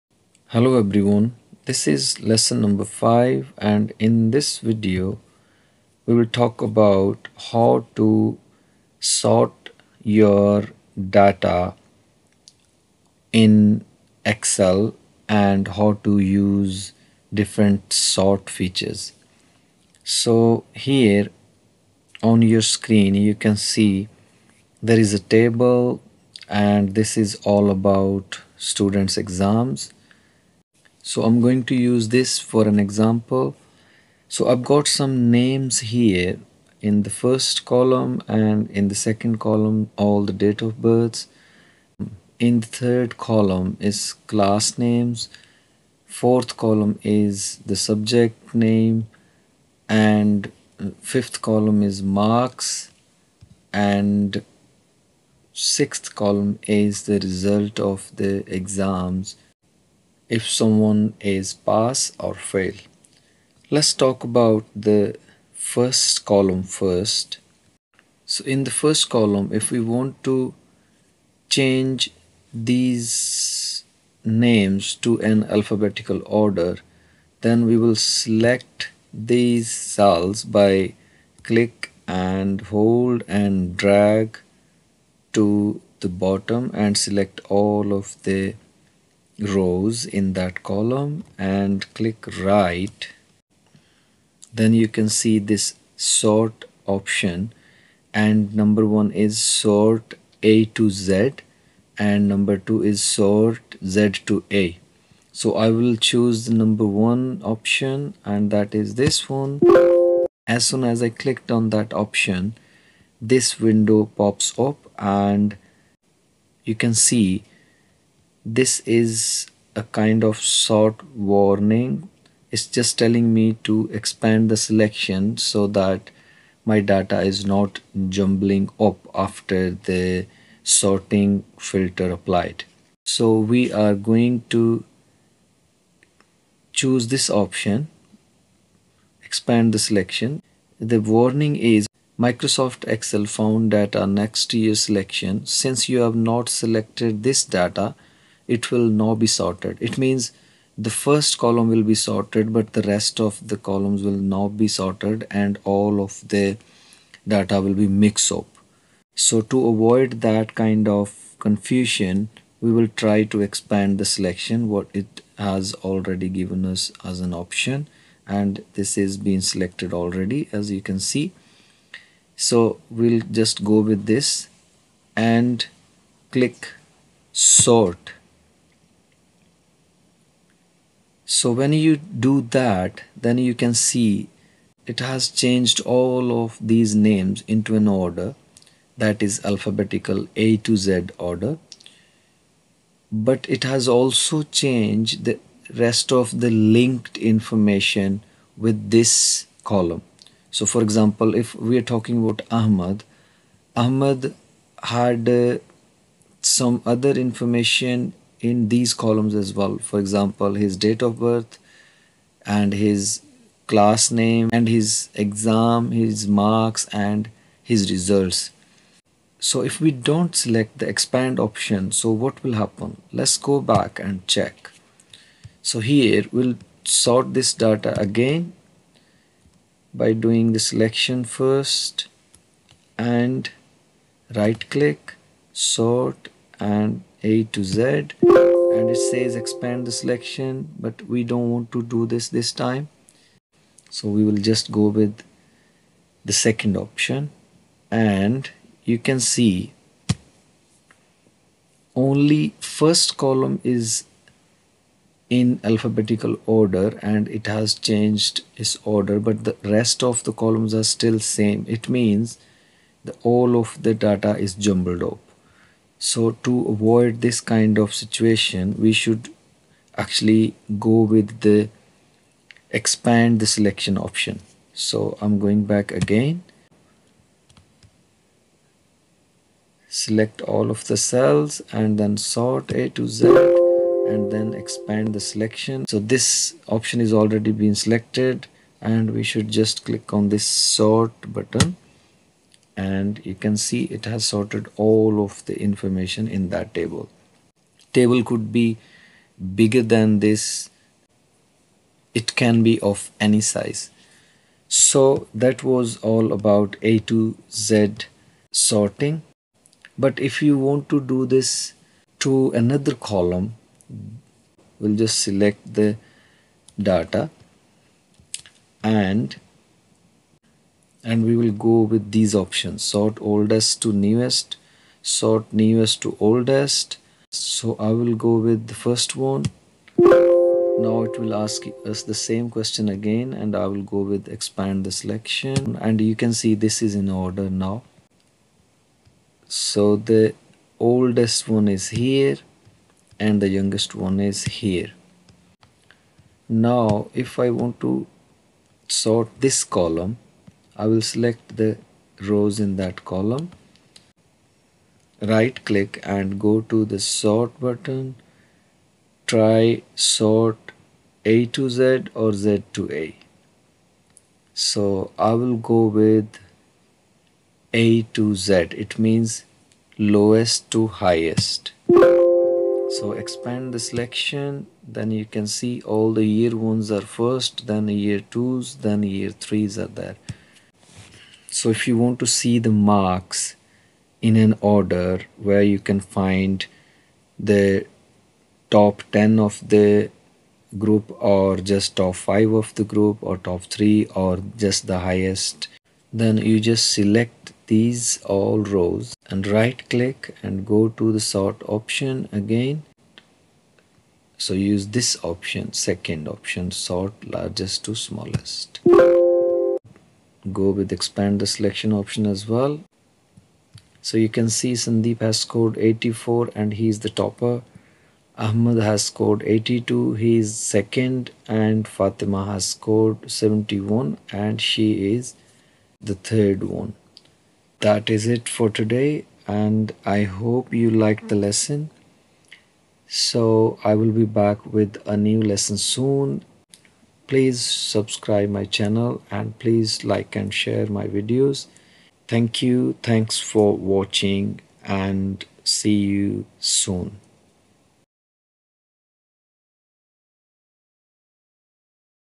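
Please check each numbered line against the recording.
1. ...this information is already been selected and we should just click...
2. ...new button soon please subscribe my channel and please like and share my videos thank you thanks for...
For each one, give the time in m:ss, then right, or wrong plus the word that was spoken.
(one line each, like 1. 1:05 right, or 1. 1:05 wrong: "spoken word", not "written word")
1. 4:45 wrong: "option", not "information"
2. 7:15 wrong: "lesson", not "button".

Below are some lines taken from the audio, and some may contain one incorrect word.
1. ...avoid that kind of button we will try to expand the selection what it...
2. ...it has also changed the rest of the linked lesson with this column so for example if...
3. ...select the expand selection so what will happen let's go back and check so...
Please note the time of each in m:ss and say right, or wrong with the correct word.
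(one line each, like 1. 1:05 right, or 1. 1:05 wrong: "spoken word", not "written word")
1. 2:39 wrong: "confusion", not "button"
2. 3:13 wrong: "information", not "lesson"
3. 3:40 wrong: "option", not "selection".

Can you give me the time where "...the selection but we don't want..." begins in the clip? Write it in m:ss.
3:59.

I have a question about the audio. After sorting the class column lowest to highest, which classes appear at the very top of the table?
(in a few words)
Year ones.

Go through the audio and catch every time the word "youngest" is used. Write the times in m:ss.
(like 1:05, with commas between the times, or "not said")
5:43.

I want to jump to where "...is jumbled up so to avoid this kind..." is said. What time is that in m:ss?
4:24.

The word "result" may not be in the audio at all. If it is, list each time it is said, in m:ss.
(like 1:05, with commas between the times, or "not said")
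0:57, 3:37.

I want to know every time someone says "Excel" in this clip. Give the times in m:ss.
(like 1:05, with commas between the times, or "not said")
0:14, 2:22.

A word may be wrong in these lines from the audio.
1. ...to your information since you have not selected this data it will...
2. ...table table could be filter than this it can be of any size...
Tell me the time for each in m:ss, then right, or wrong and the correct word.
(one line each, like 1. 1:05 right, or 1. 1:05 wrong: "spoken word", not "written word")
1. 2:24 wrong: "selection", not "information"
2. 4:56 wrong: "bigger", not "filter".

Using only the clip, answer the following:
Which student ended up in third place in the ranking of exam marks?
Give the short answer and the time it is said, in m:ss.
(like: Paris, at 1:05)
Fatima, at 7:01.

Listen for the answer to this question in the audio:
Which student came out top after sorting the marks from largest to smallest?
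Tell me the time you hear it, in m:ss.
6:54.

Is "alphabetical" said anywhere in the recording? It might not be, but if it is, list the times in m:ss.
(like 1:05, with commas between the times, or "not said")
1:15, 3:09, 4:15.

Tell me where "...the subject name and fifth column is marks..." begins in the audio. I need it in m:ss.
0:47.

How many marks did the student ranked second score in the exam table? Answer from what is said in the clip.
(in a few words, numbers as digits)
82.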